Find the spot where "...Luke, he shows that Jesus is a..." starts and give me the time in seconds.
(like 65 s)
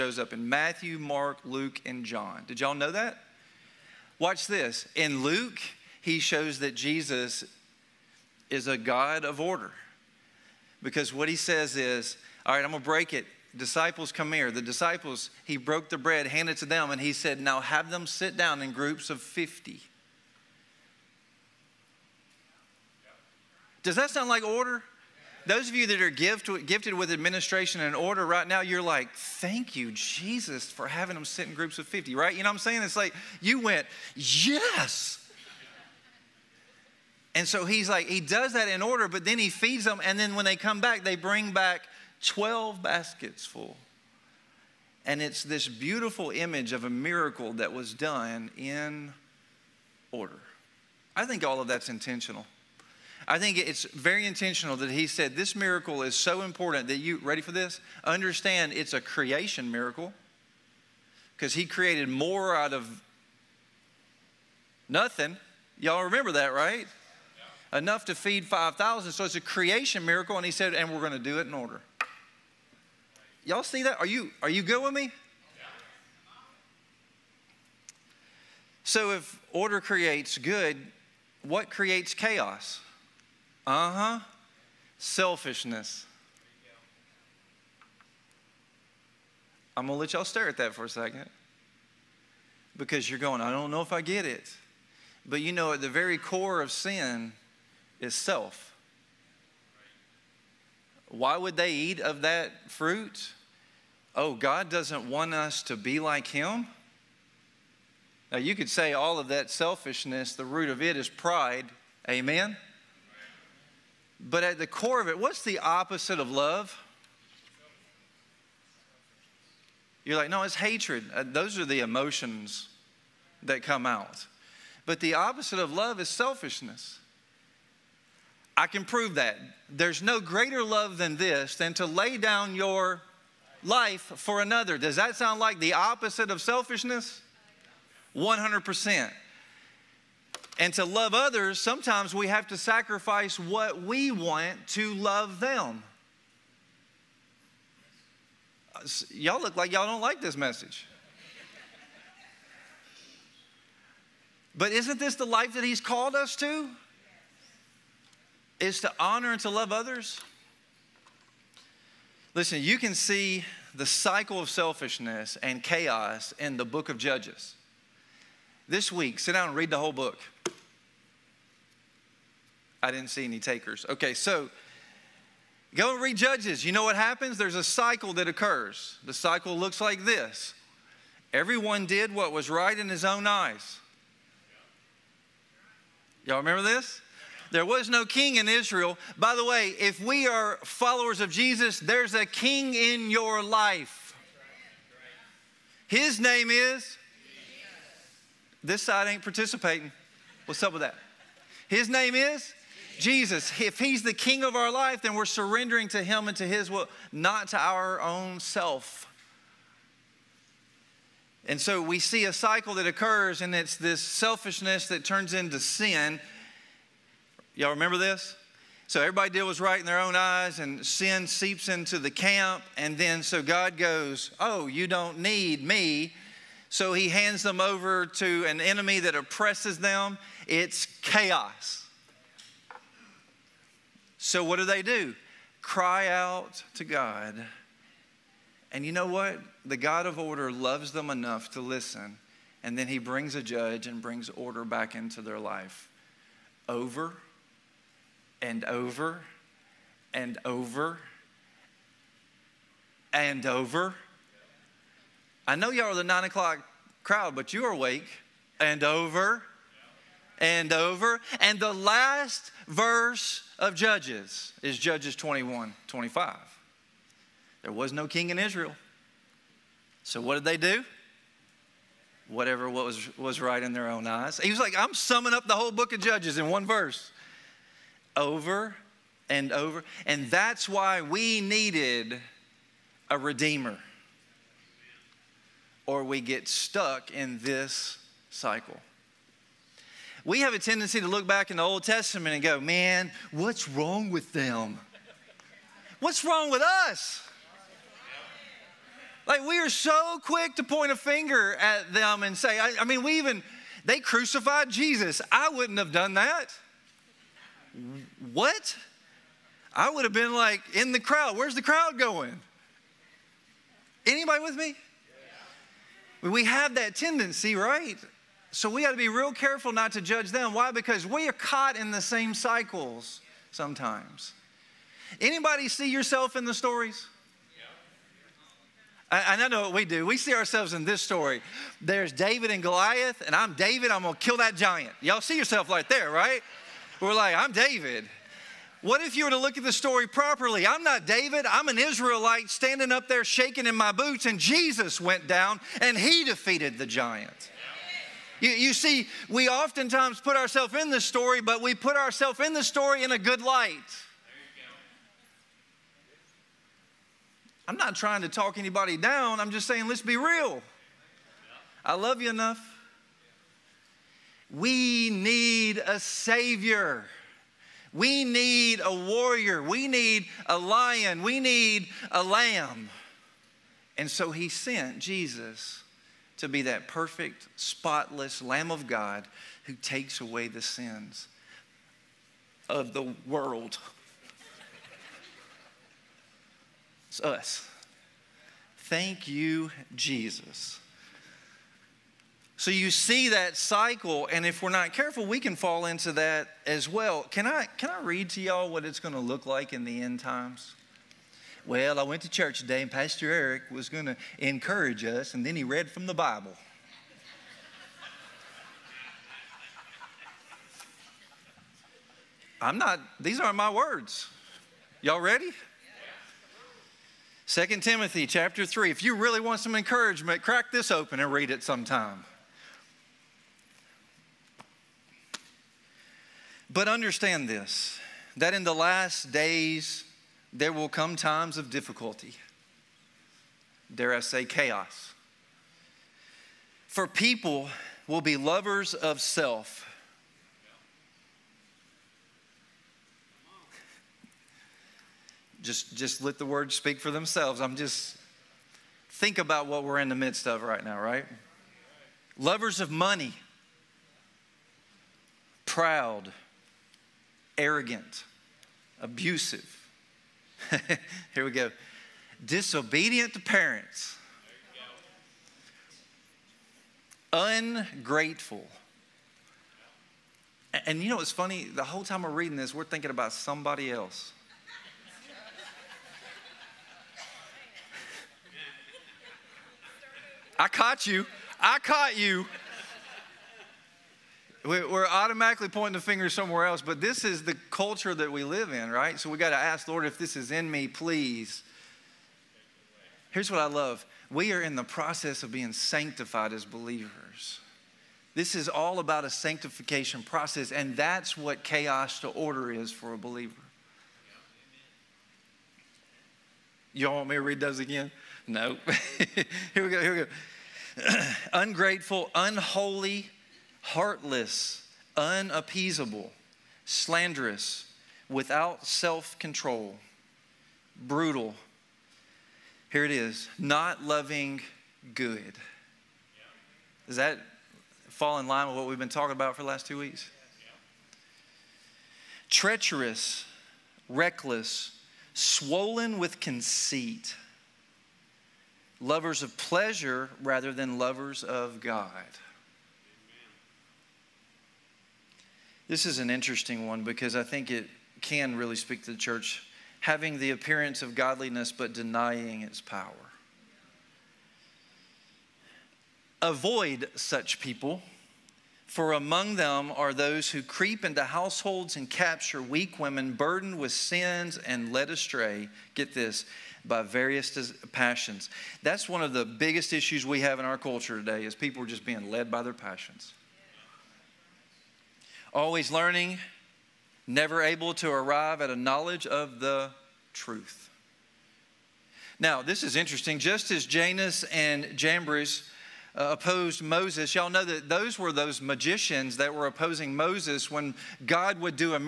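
5 s.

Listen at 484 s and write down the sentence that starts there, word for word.
We're automatically pointing the finger somewhere else, but this is the culture that we live in, right?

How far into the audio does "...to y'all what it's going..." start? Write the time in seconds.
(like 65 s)
398 s.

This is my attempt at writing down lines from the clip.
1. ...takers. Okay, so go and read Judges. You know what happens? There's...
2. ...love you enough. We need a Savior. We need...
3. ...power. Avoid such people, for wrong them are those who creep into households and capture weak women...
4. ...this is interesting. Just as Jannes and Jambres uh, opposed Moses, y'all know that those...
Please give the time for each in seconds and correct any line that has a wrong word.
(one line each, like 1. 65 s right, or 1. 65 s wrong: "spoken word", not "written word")
1. 173 s right
2. 361 s right
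3. 552 s wrong: "among", not "wrong"
4. 582 s right.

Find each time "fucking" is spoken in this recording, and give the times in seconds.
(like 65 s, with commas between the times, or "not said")
not said.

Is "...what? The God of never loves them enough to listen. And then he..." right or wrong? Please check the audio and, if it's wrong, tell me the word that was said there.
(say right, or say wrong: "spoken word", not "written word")
wrong: "order", not "never".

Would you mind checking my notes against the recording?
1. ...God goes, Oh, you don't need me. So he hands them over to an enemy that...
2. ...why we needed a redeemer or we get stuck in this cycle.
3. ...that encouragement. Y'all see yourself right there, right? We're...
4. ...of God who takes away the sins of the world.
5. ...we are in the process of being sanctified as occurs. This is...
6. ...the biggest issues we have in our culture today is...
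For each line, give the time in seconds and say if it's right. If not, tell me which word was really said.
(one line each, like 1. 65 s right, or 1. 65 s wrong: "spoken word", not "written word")
1. 223 s right
2. 280 s right
3. 334 s wrong: "giant", not "encouragement"
4. 378 s right
5. 494 s wrong: "believers", not "occurs"
6. 569 s right.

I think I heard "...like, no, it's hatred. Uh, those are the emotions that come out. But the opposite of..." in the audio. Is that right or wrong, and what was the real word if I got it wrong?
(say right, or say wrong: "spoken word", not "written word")
right.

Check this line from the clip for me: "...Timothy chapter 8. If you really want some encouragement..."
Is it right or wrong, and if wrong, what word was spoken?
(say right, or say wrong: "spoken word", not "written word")
wrong: "3", not "8".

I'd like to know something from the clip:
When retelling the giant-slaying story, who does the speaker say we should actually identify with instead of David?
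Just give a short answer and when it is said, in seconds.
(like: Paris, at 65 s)
an Israelite, at 341 s.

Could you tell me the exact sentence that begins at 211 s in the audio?
And so we see a cycle that occurs, and it's this selfishness that turns into sin.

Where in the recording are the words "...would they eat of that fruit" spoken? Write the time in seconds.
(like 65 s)
101 s.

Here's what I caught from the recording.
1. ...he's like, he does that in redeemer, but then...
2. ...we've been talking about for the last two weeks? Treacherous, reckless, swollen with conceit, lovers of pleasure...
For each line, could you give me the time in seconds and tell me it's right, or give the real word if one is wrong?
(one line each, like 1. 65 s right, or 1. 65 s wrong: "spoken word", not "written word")
1. 37 s wrong: "order", not "redeemer"
2. 528 s right.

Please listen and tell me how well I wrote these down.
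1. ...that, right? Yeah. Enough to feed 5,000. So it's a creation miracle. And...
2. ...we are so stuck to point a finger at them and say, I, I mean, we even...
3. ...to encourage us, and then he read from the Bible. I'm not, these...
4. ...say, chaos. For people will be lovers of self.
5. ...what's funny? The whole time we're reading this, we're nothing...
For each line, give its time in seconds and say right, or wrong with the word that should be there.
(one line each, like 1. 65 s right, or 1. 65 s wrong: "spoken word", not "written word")
1. 66 s right
2. 299 s wrong: "quick", not "stuck"
3. 404 s right
4. 434 s right
5. 471 s wrong: "thinking", not "nothing".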